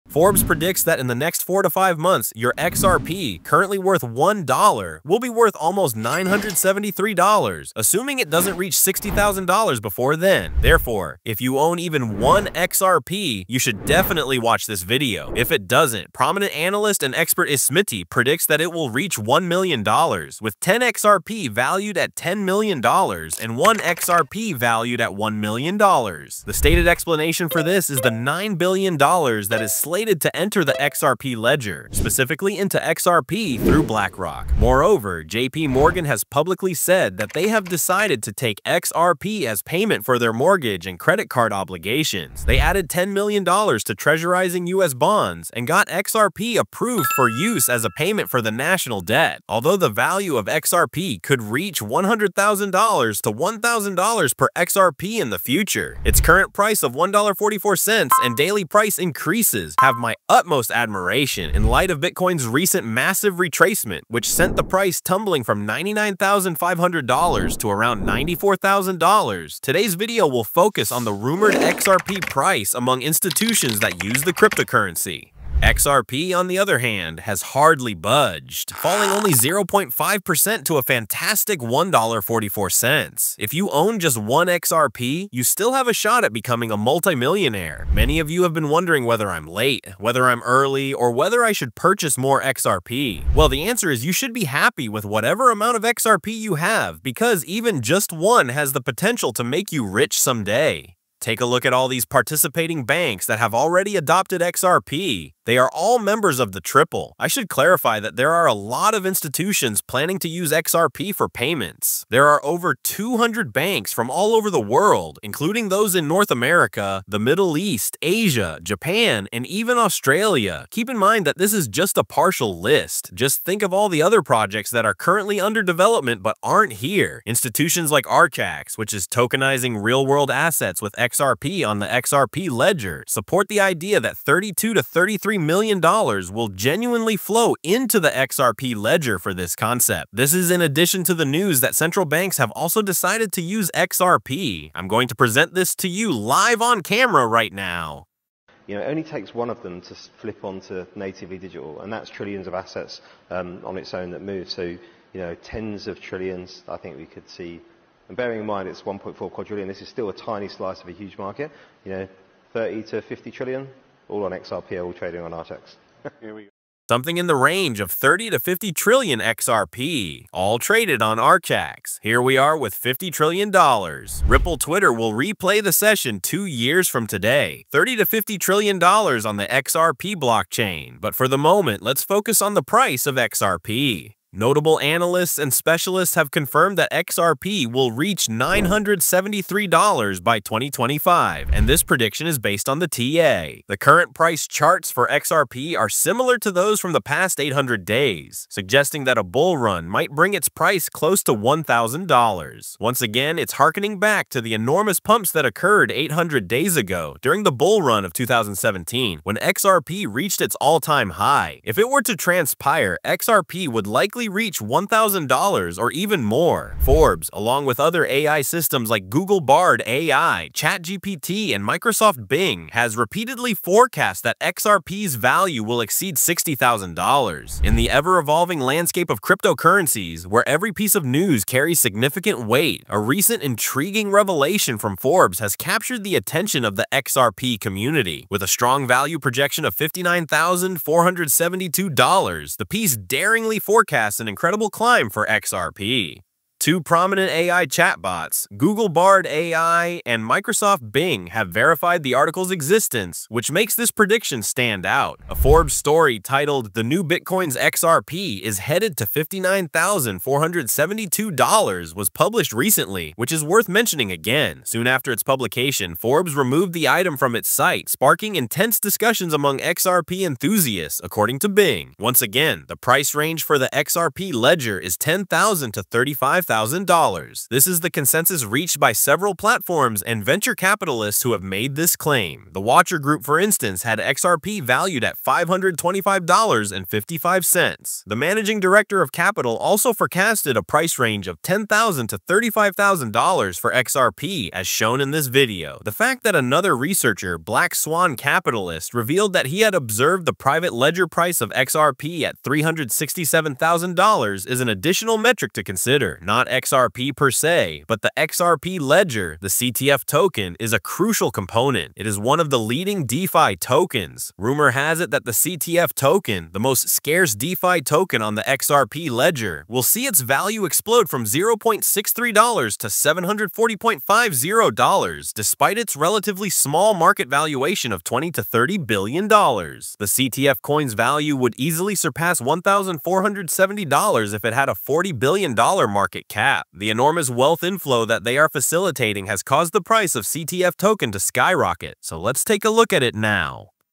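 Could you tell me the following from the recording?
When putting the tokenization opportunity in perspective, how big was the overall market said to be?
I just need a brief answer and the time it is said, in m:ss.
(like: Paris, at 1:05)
1.4 quadrillion, at 2:38.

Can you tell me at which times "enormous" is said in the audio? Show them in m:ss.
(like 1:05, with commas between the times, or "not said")
3:24, 5:36.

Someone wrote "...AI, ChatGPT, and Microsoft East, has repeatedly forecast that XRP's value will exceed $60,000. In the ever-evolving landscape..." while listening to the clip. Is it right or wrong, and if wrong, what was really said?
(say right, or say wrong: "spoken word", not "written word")
wrong: "Bing", not "East".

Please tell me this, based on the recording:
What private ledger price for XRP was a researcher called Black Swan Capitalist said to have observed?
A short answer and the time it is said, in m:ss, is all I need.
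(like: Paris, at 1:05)
$367,000, at 5:02.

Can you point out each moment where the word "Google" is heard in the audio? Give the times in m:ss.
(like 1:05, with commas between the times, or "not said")
3:39, 4:08.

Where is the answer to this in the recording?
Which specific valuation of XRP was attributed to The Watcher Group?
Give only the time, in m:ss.
4:45.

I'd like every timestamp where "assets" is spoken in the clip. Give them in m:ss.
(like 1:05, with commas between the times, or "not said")
2:10, 2:32.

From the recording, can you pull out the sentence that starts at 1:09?
Today's video will focus on the rumored XRP price among institutions that use the cryptocurrency.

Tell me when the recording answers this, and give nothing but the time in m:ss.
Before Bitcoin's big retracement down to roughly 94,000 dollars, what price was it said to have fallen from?
1:05.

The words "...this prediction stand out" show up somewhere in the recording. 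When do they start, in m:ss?
4:13.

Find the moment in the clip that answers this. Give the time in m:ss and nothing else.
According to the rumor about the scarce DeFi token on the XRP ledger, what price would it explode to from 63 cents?
5:22.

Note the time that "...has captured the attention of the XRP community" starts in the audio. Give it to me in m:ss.
3:55.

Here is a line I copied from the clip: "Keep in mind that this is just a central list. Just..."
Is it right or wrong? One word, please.
wrong.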